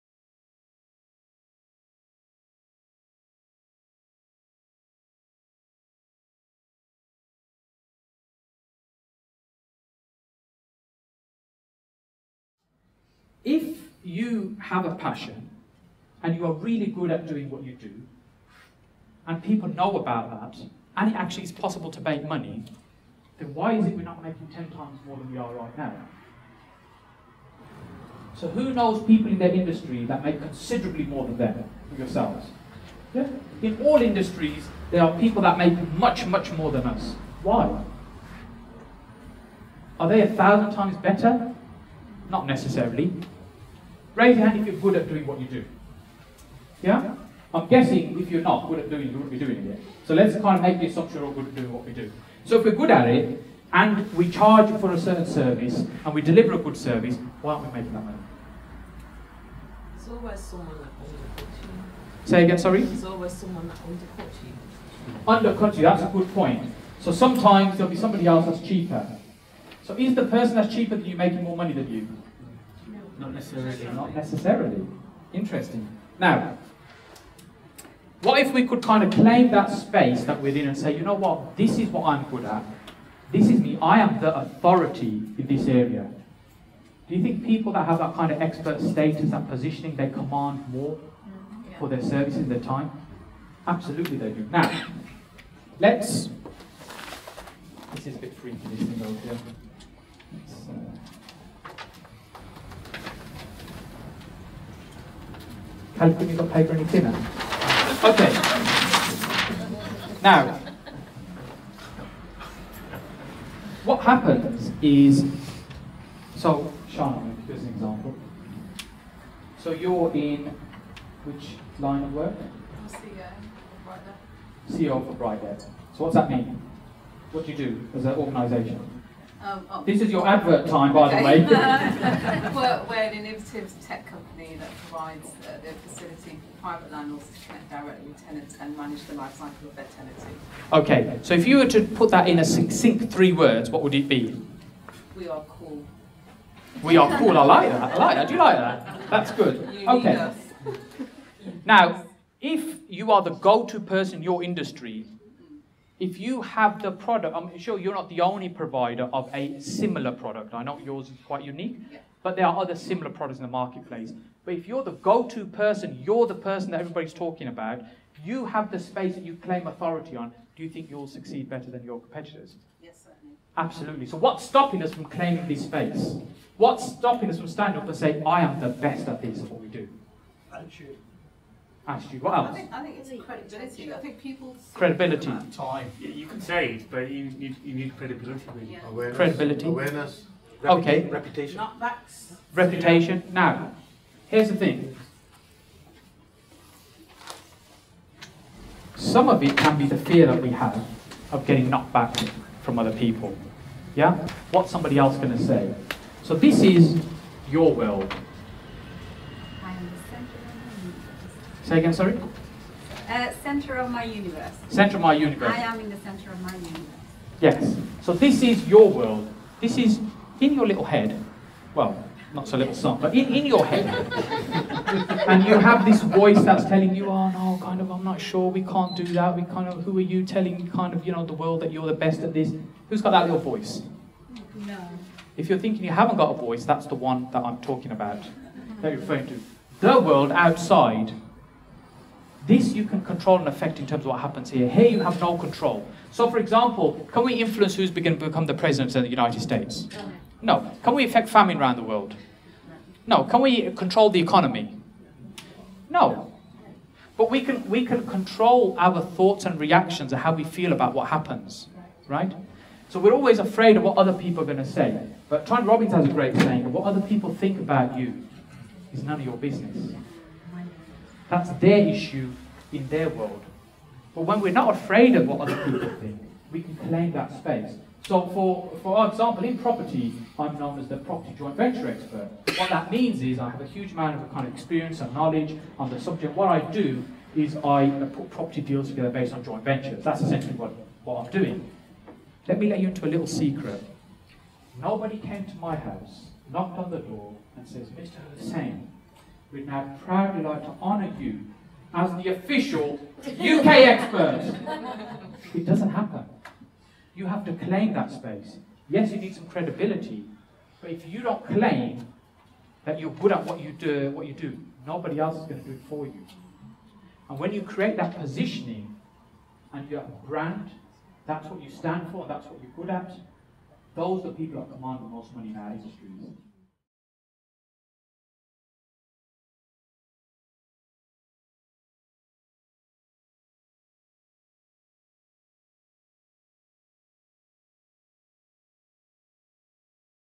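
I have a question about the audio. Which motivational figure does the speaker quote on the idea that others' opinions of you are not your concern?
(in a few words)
Tony Robbins.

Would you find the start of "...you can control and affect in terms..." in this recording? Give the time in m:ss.
4:02.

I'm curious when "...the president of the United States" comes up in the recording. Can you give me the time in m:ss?
4:08.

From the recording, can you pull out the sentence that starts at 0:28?
So who knows people in their industry that make considerably more than them, yourselves?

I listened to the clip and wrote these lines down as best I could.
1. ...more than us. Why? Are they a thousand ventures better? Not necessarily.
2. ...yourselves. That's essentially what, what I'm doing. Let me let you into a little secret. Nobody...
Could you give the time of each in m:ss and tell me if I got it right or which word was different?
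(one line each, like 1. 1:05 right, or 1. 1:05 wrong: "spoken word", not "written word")
1. 0:36 wrong: "times", not "ventures"
2. 4:49 wrong: "ventures", not "yourselves".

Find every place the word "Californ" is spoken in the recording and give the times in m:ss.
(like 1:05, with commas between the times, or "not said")
1:45.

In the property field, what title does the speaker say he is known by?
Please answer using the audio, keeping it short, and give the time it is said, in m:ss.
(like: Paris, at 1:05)
property joint venture expert, at 4:40.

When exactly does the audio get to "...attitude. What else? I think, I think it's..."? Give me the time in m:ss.
3:01.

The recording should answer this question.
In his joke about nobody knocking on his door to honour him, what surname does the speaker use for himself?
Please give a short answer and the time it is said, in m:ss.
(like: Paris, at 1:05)
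Hussain, at 4:58.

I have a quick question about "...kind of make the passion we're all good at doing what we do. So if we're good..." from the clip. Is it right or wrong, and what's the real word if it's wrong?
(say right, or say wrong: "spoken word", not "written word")
wrong: "assumption", not "passion".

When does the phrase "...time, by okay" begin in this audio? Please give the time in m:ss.
2:10.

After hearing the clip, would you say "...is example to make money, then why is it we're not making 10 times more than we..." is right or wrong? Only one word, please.
wrong.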